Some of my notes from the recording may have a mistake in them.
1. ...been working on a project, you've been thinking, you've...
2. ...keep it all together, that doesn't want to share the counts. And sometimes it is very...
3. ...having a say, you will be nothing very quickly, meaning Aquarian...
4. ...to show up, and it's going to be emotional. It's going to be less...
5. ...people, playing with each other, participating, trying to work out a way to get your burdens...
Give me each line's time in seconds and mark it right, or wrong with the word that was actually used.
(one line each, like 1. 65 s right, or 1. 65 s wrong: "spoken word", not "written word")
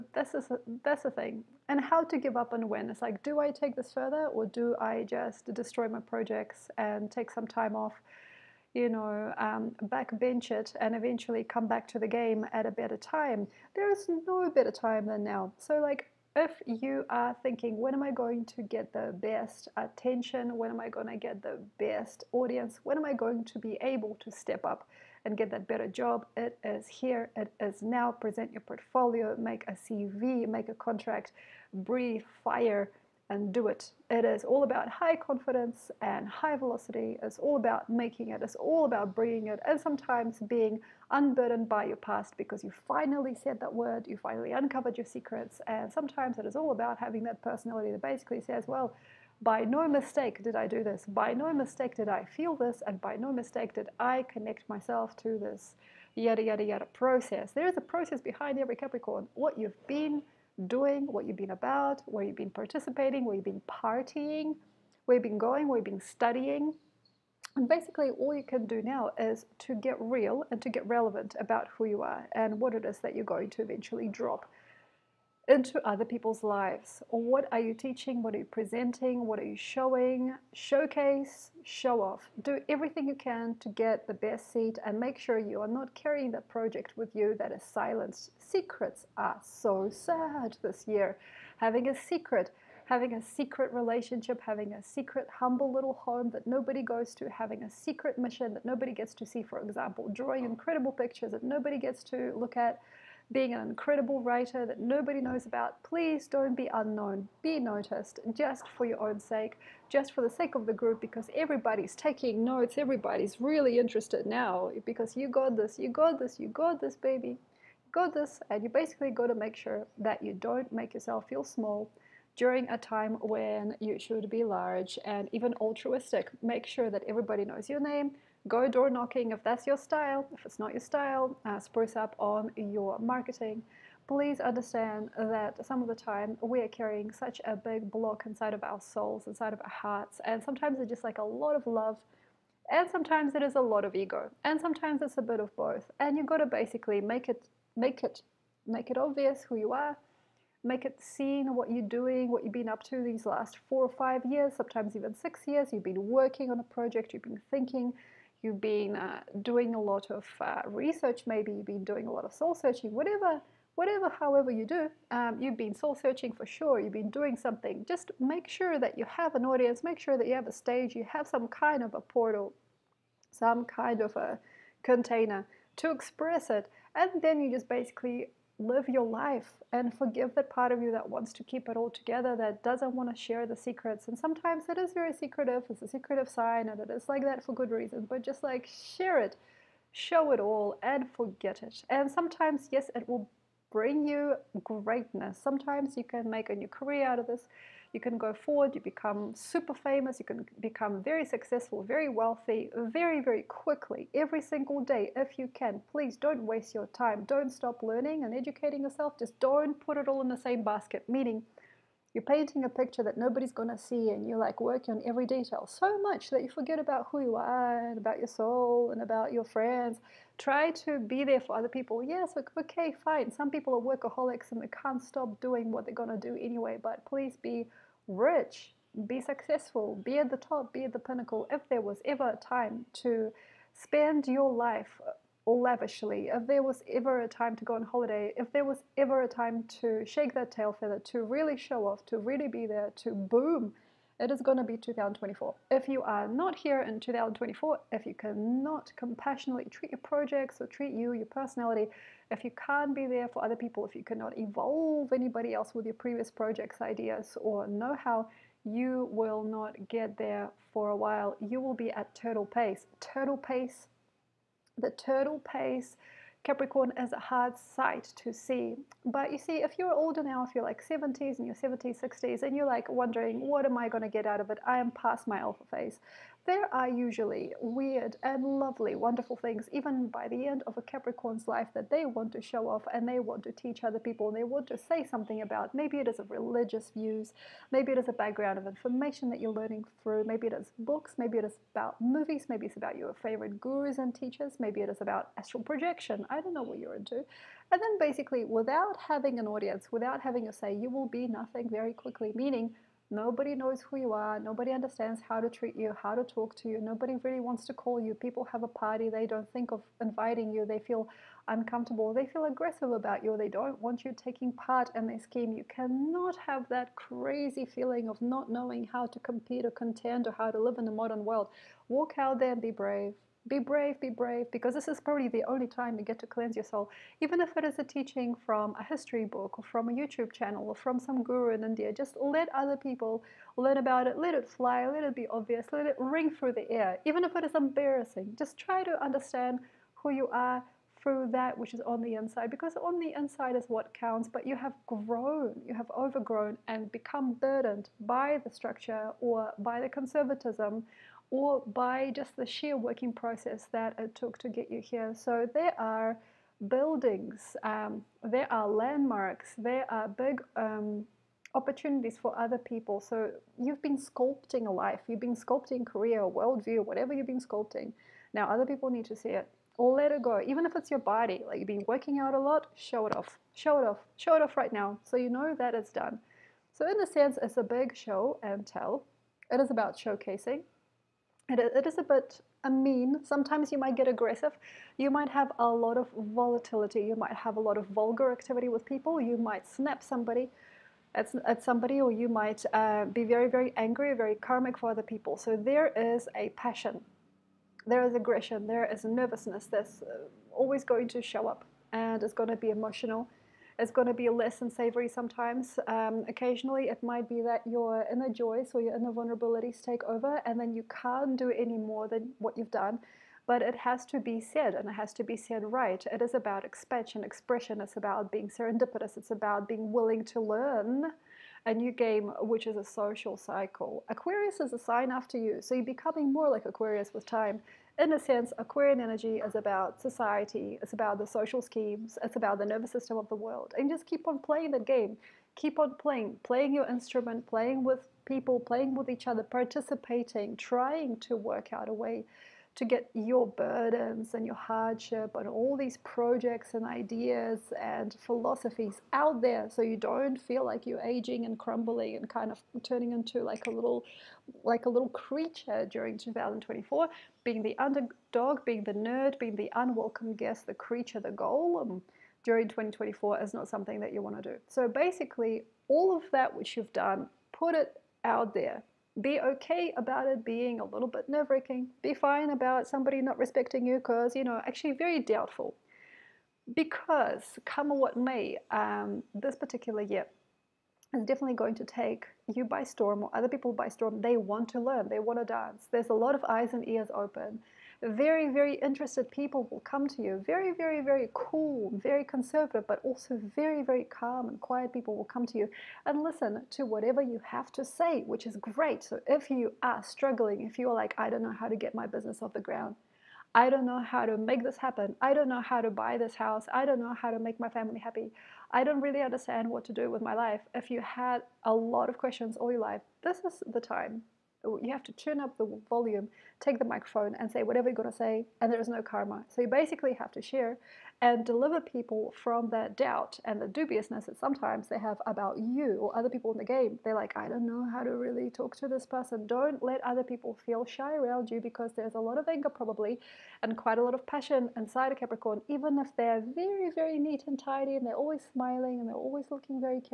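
1. 155 s right
2. 181 s wrong: "secrets", not "counts"
3. 300 s wrong: "Nobody", not "Aquarian"
4. 401 s right
5. 438 s right.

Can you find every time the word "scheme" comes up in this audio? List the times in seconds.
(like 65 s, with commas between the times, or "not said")
315 s, 431 s.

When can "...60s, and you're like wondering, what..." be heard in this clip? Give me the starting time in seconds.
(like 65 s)
272 s.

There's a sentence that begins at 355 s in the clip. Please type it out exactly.
So there are buildings, um, there are landmarks, there are big um, opportunities for other people.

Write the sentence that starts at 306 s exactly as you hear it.
Nobody really wants to call you.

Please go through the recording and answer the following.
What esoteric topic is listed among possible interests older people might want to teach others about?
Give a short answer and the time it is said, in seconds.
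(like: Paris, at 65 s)
Astral projection, at 295 s.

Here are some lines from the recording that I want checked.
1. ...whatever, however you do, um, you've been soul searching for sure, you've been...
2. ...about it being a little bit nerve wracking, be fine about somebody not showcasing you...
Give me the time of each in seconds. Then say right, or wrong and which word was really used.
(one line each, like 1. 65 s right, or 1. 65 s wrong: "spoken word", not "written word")
1. 163 s right
2. 469 s wrong: "respecting", not "showcasing".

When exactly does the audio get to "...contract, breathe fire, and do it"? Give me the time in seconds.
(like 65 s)
30 s.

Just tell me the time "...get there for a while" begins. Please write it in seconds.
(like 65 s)
259 s.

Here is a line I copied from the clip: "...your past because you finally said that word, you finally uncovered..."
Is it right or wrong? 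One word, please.
right.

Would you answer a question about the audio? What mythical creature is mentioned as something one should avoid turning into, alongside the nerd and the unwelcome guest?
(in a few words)
Golem.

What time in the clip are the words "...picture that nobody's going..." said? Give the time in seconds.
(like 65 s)
212 s.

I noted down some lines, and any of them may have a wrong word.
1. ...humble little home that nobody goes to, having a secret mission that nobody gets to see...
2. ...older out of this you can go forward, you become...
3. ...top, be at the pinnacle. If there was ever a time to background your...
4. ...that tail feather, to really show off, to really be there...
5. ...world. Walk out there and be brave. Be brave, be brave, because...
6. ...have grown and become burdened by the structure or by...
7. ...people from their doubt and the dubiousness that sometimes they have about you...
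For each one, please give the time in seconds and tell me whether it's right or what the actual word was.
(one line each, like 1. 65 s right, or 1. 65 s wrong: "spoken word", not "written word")
1. 95 s right
2. 196 s wrong: "career", not "older"
3. 230 s wrong: "spend", not "background"
4. 240 s right
5. 321 s right
6. 345 s wrong: "overgrown", not "grown"
7. 521 s right.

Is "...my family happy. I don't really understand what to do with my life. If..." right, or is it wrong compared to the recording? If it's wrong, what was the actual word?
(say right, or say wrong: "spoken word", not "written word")
right.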